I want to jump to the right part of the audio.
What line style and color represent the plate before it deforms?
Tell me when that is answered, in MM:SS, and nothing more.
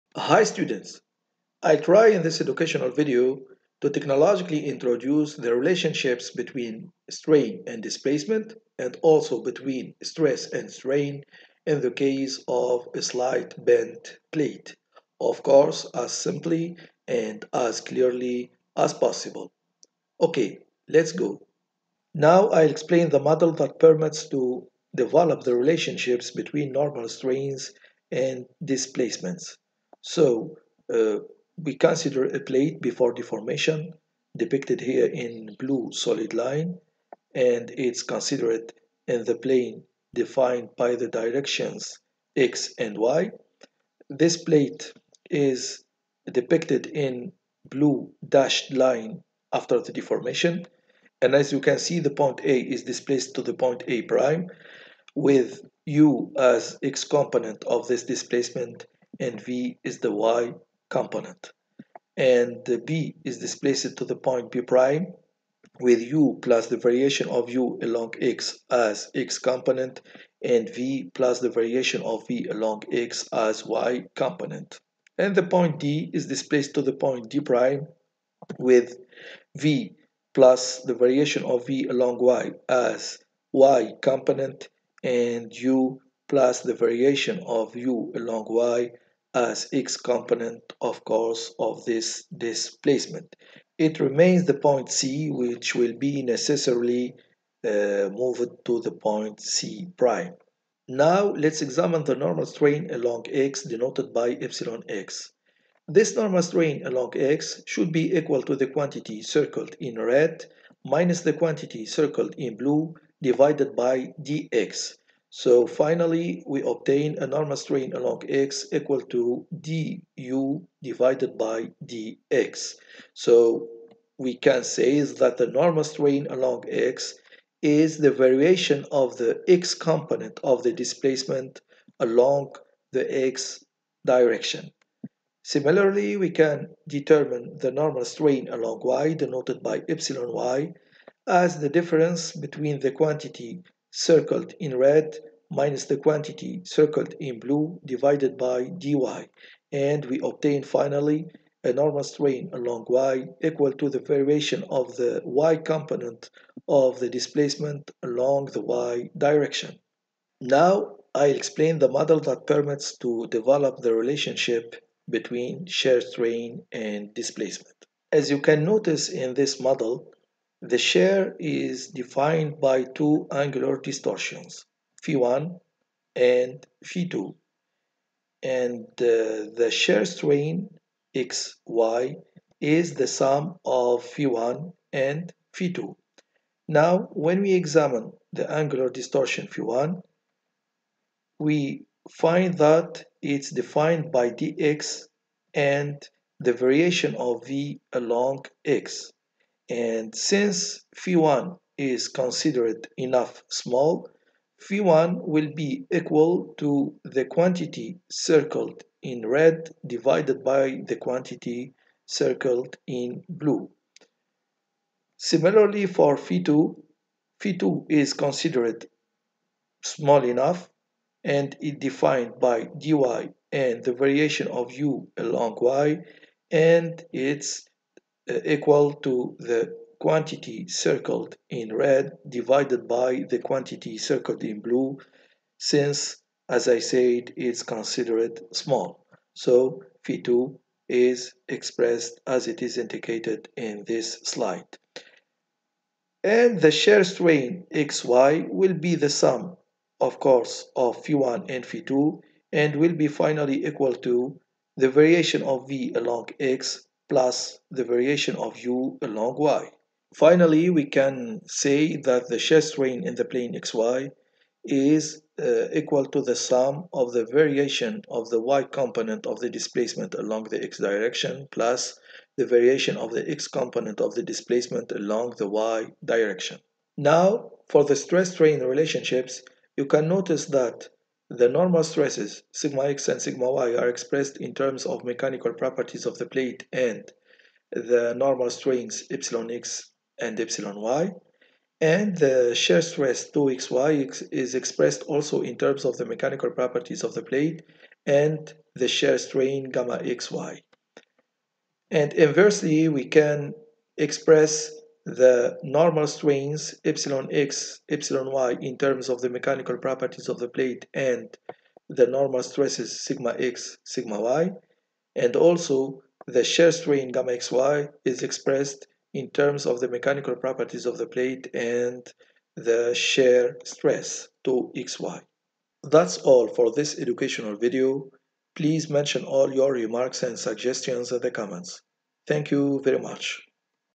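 00:35.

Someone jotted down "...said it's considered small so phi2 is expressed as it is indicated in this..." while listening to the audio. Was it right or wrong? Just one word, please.
right.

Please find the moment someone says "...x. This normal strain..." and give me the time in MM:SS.
01:44.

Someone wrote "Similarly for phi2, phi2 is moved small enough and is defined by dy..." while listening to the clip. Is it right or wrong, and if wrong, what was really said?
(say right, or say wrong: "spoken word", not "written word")
wrong: "considered", not "moved".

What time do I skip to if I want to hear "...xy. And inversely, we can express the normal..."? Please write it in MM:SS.
05:00.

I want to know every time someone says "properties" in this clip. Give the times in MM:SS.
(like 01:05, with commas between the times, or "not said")
04:45, 04:56, 05:09, 05:20.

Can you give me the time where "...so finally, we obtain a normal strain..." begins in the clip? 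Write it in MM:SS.
01:55.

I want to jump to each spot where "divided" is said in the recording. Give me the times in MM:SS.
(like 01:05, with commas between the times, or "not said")
01:53, 02:00, 02:27, 03:29, 03:52.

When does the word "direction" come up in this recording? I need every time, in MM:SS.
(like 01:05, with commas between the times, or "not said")
00:41, 02:14, 02:39, 04:30, 04:36.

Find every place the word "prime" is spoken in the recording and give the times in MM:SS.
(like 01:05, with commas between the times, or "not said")
00:54, 01:04, 01:17, 01:39.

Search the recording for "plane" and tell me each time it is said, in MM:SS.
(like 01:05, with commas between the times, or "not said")
00:39, 04:23.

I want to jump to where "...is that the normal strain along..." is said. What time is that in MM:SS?
02:04.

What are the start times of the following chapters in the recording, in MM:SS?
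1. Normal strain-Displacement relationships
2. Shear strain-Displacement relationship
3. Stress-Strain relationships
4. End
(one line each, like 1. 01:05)
1. 00:23
2. 02:41
3. 04:37
4. 05:26.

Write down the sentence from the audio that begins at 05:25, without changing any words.
That's all for this educational video.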